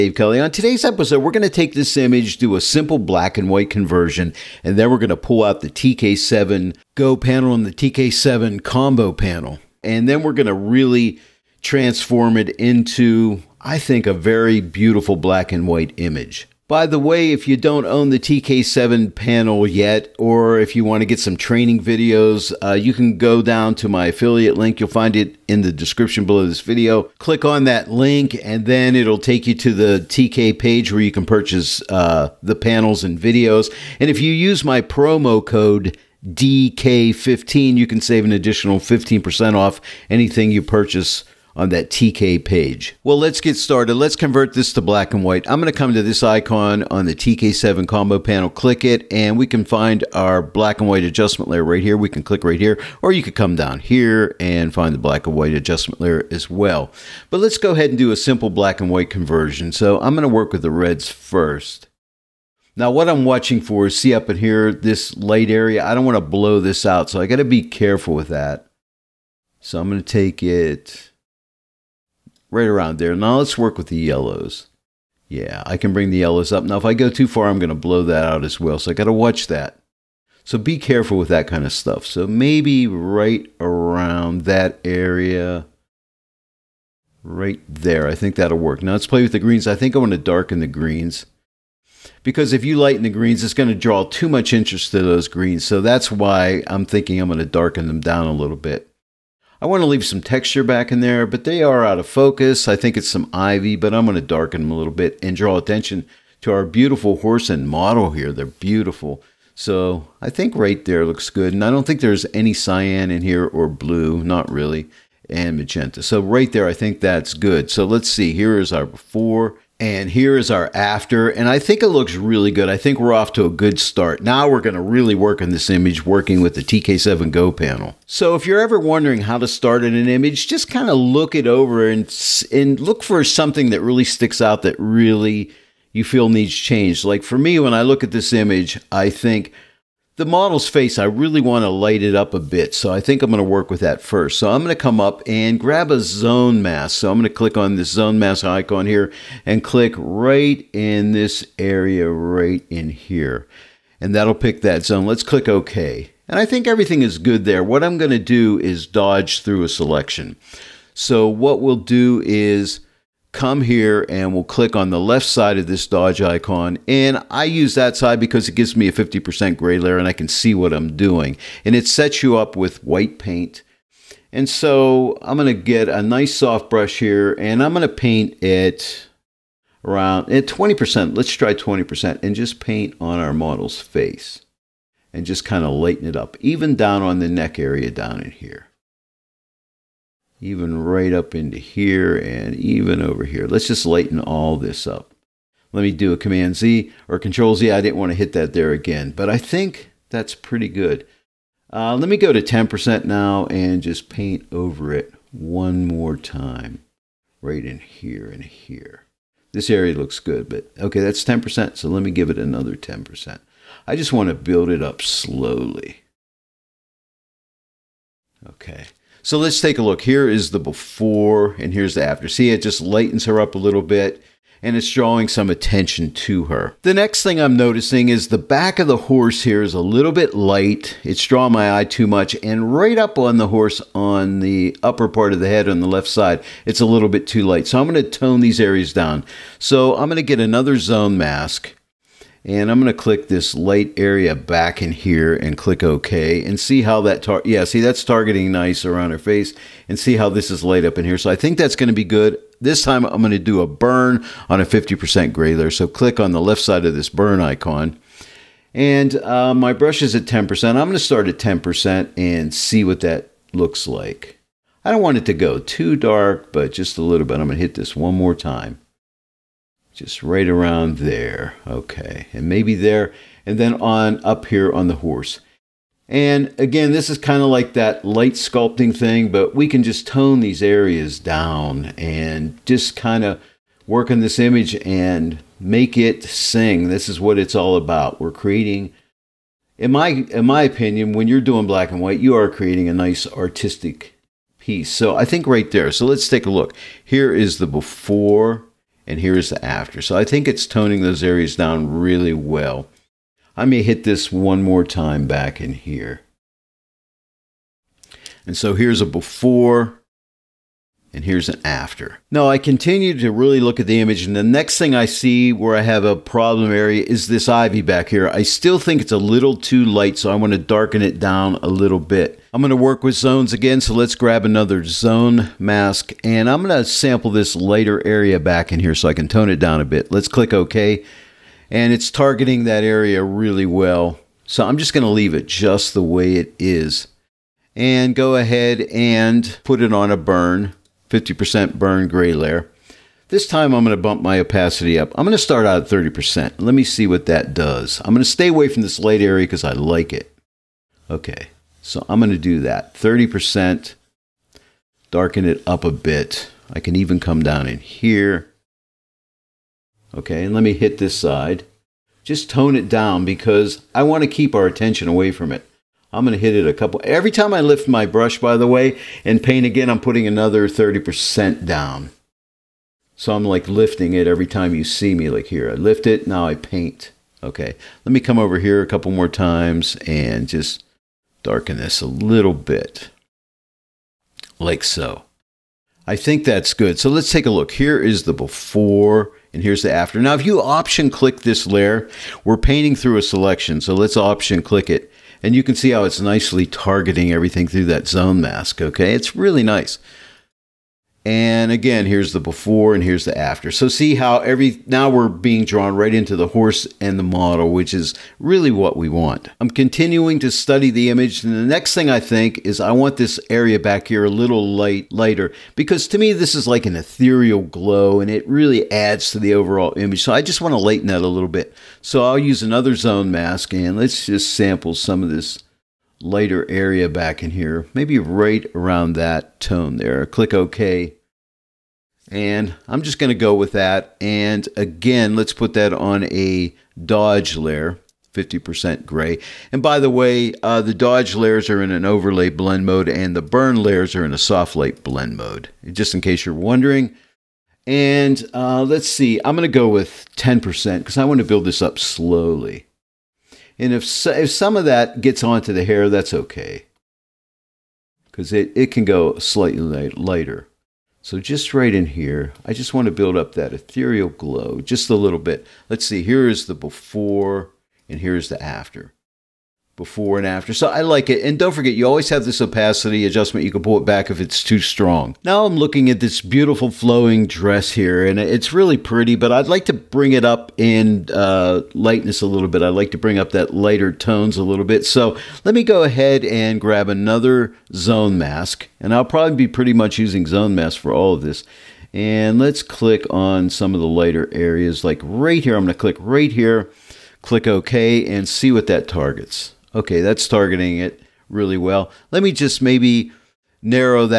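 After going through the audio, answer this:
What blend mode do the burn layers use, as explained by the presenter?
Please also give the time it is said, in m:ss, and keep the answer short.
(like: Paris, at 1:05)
soft light, at 7:24.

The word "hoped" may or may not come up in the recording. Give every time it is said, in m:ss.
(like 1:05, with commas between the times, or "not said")
not said.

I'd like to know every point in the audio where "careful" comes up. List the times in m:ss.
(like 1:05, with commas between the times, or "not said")
1:07, 1:20.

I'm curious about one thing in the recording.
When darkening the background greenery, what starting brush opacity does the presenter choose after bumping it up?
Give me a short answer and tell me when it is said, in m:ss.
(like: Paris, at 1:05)
30%, at 5:45.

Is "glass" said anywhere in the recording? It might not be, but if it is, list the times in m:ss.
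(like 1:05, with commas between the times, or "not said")
not said.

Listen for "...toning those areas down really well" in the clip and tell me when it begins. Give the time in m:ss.
5:00.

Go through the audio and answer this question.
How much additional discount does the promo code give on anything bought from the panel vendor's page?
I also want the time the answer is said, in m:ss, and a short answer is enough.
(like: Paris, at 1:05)
15%, at 0:38.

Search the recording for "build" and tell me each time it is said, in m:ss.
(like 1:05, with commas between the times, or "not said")
3:34, 7:31, 7:43.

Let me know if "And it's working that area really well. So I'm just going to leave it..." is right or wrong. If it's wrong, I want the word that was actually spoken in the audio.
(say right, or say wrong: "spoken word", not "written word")
wrong: "targeting", not "working".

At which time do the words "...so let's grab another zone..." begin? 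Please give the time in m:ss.
5:23.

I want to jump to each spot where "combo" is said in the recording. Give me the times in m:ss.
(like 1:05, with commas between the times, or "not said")
0:08, 0:47.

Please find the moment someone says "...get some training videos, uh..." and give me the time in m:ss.
0:21.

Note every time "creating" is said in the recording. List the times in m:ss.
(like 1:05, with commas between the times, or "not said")
4:48, 4:52.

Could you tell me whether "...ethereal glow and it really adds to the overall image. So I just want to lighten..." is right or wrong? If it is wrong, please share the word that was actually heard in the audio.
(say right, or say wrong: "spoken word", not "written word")
right.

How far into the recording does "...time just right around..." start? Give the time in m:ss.
4:28.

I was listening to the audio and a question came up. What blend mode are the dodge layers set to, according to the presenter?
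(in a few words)
overlay.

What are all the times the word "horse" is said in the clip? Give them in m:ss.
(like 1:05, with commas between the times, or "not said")
1:47, 3:48, 3:53, 4:34, 6:46.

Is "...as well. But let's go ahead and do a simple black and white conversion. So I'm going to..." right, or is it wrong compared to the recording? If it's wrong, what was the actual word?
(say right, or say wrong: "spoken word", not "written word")
right.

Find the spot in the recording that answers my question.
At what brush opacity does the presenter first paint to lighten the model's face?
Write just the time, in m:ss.
3:01.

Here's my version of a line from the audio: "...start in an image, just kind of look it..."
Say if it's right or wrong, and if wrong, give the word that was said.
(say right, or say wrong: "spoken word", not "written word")
right.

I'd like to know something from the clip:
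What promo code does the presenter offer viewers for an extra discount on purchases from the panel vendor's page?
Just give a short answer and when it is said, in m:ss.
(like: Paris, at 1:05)
DK15, at 0:36.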